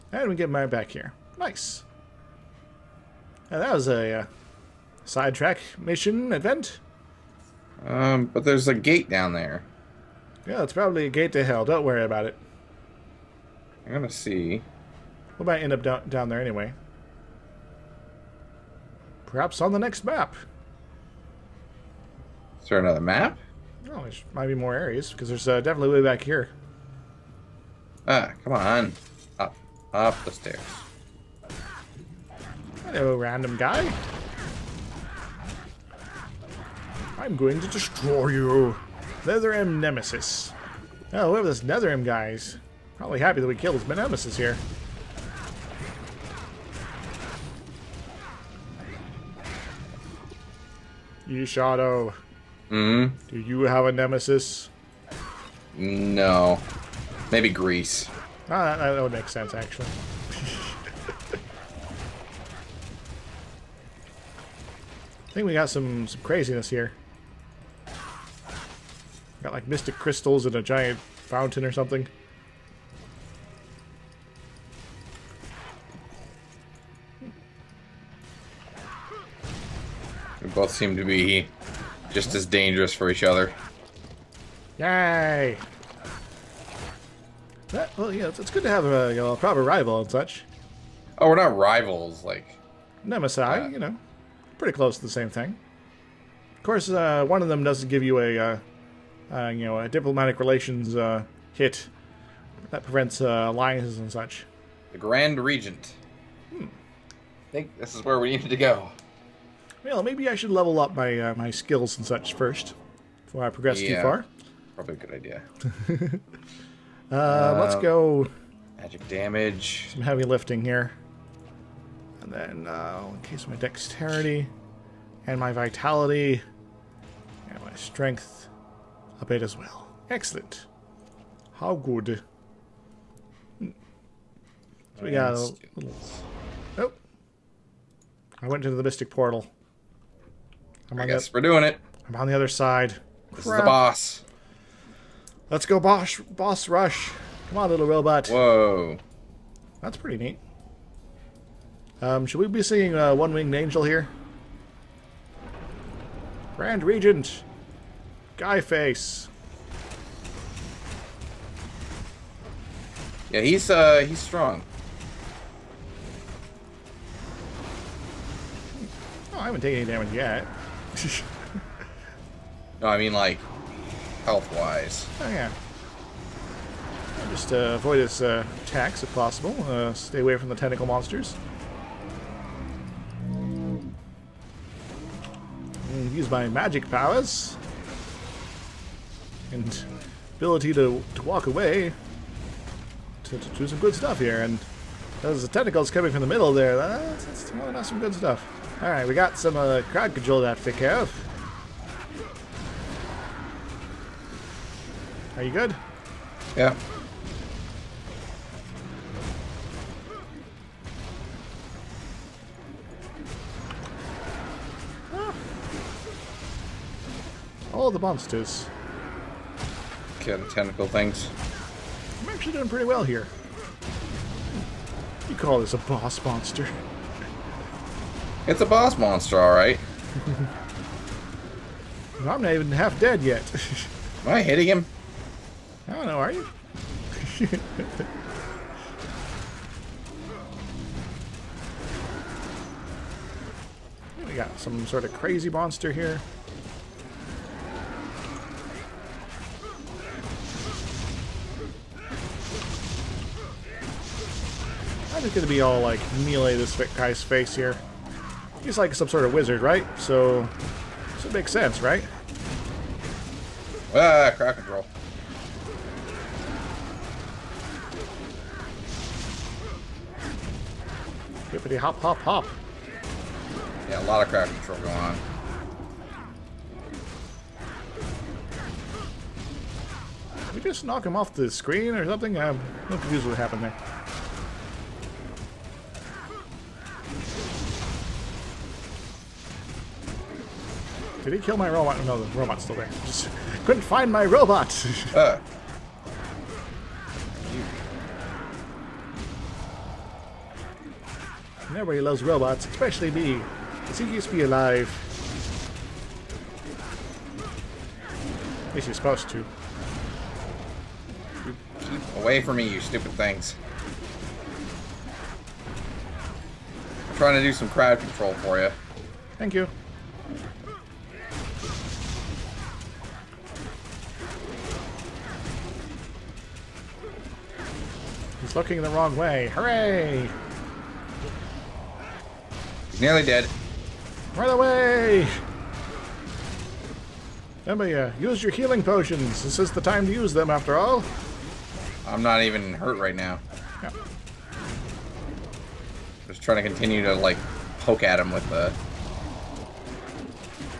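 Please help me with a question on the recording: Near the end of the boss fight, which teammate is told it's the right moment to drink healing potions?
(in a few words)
Emilia.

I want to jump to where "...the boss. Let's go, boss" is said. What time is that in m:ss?
2:23.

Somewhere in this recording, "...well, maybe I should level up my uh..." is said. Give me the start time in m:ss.
1:49.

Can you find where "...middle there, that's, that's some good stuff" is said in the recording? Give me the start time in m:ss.
3:16.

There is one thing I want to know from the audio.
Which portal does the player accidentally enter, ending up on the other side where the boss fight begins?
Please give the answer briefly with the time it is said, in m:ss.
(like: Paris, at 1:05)
Mystic Portal, at 2:18.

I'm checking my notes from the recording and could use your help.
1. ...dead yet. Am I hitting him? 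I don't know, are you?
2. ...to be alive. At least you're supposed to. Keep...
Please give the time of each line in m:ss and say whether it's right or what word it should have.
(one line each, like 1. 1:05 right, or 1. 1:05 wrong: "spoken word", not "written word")
1. 3:52 right
2. 5:04 right.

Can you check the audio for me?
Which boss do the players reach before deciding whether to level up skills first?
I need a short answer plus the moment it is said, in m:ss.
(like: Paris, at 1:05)
The Grand Regent, at 1:44.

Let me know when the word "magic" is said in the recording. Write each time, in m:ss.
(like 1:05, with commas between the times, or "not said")
1:58, 3:06.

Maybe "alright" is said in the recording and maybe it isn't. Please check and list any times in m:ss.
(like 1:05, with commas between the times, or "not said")
3:18, 3:49.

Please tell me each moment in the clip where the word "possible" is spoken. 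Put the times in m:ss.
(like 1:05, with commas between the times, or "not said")
2:59.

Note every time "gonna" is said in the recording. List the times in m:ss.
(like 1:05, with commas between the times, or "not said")
0:13, 4:15.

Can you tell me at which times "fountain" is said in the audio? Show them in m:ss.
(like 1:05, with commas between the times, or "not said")
1:10.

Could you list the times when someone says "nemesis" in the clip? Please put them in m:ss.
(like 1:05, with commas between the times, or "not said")
0:39, 0:43, 0:53, 1:33.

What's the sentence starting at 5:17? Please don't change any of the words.
I'm trying to do some crowd control for you.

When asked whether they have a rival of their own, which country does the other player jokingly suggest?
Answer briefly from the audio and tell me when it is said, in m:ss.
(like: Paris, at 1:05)
Greece, at 0:57.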